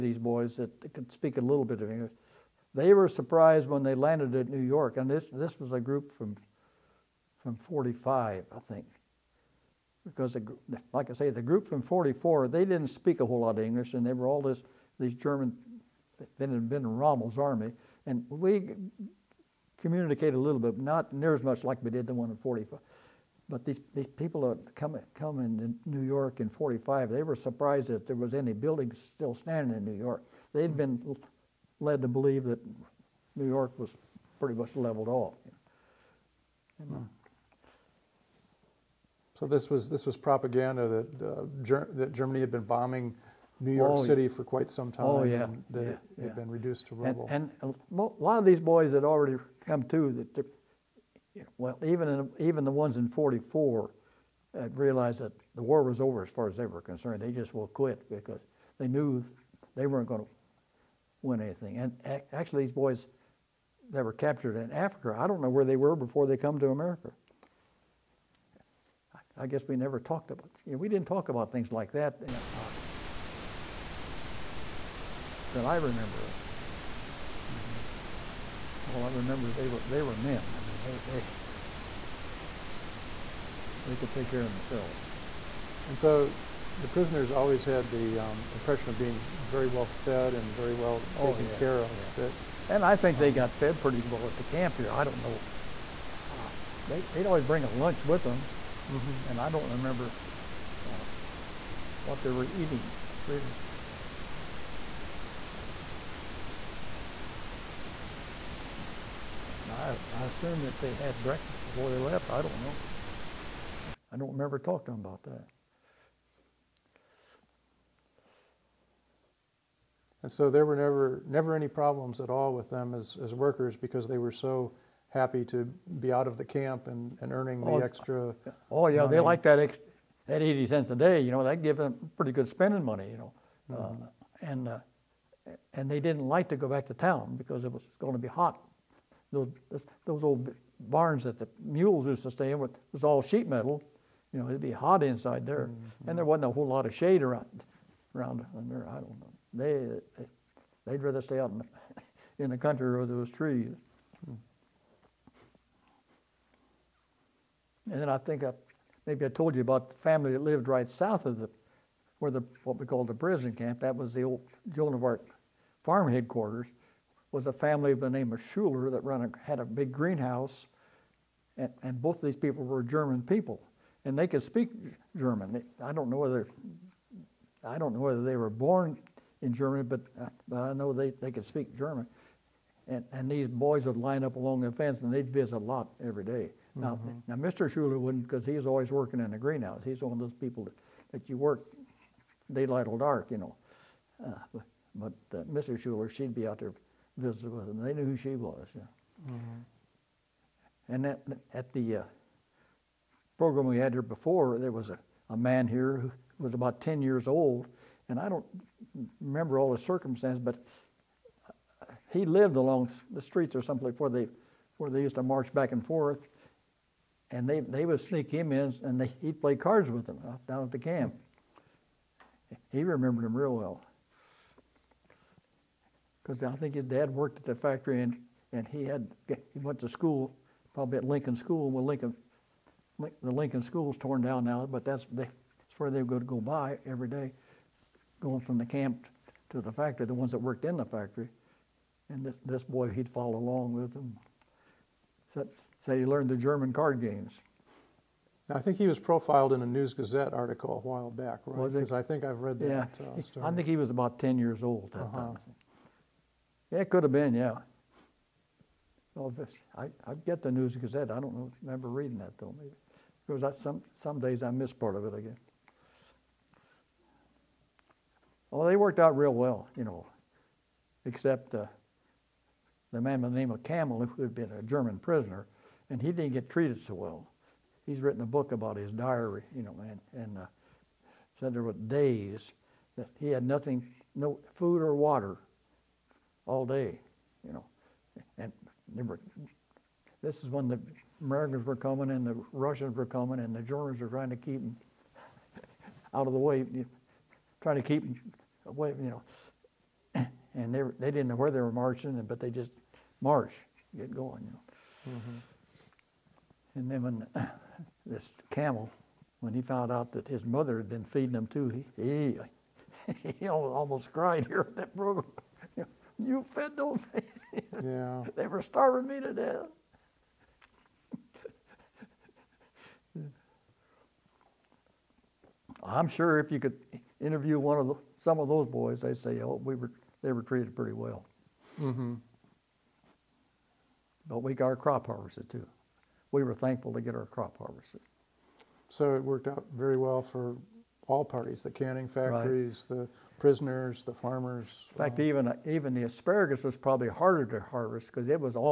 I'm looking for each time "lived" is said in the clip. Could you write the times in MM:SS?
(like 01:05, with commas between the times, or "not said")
02:40, 03:32.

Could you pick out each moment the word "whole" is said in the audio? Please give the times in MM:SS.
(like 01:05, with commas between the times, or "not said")
00:13, 02:26.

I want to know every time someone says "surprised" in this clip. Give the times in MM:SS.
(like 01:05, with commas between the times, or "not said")
00:03, 00:27.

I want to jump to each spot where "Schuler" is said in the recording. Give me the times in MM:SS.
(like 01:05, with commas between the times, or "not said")
02:48, 03:07, 03:15.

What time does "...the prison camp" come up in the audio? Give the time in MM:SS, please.
02:43.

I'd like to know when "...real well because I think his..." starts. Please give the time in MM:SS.
03:43.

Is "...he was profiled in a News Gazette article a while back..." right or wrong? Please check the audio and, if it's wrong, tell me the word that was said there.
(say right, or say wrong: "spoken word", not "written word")
right.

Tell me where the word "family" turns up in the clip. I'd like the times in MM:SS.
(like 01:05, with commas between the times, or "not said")
02:39, 02:47.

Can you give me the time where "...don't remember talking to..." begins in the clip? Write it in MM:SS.
01:54.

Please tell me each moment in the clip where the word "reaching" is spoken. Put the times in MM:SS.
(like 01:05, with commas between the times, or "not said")
not said.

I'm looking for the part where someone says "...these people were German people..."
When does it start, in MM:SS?
02:52.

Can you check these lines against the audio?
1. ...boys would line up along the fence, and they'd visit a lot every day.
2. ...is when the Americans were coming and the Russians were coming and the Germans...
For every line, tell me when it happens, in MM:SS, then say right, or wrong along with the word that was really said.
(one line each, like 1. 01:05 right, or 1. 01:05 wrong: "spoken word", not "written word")
1. 03:03 right
2. 04:50 right.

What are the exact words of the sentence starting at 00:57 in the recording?
They just will quit because they knew they weren't going to win anything.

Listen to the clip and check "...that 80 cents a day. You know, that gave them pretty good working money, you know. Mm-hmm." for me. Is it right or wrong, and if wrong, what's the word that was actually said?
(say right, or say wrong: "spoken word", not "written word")
wrong: "spending", not "working".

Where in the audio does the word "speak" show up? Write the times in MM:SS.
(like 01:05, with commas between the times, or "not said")
00:01, 00:12, 02:54, 03:01.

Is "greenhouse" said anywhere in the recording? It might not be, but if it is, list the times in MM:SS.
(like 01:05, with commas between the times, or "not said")
02:49, 03:09.